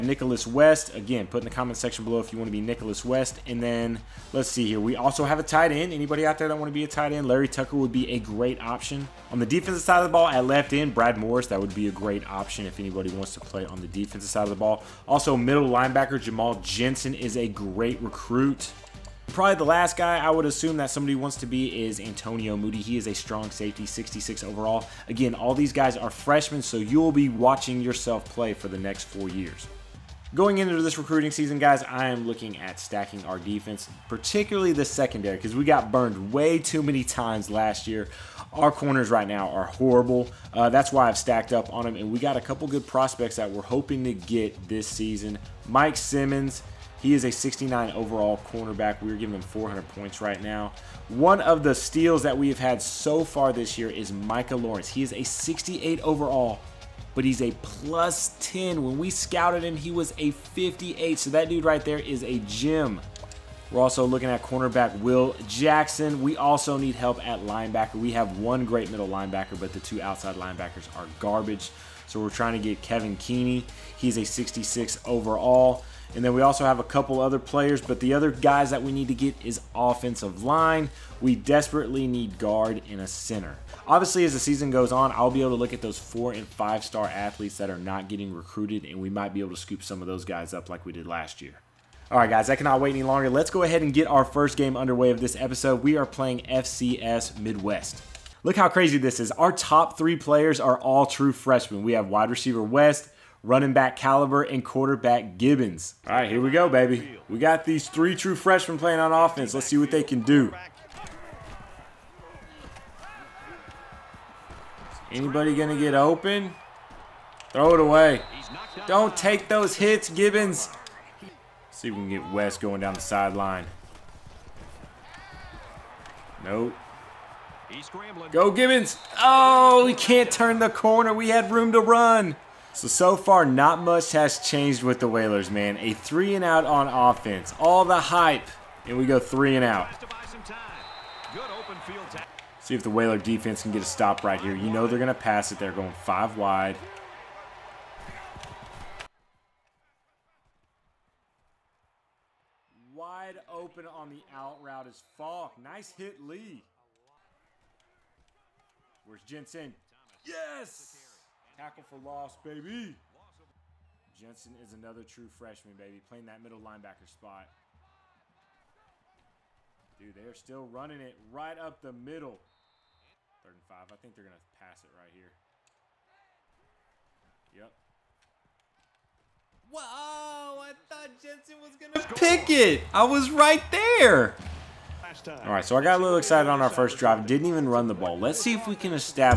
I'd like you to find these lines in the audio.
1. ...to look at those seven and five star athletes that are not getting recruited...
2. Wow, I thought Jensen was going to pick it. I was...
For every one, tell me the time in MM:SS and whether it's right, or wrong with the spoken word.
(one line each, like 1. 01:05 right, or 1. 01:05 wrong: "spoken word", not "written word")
1. 01:25 wrong: "four", not "seven"
2. 02:59 right.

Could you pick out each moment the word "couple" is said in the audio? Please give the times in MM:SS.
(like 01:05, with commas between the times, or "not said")
00:42, 01:16.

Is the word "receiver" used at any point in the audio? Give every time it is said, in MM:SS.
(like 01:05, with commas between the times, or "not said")
01:42.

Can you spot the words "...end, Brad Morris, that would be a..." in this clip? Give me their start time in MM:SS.
00:10.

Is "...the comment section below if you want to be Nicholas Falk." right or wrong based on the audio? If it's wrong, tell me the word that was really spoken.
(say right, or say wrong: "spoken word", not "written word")
wrong: "West", not "Falk".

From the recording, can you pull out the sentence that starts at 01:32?
All right, guys, I cannot wait any longer.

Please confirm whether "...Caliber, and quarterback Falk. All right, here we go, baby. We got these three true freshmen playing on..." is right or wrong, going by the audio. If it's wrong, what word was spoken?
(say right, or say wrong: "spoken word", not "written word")
wrong: "Gibbons", not "Falk".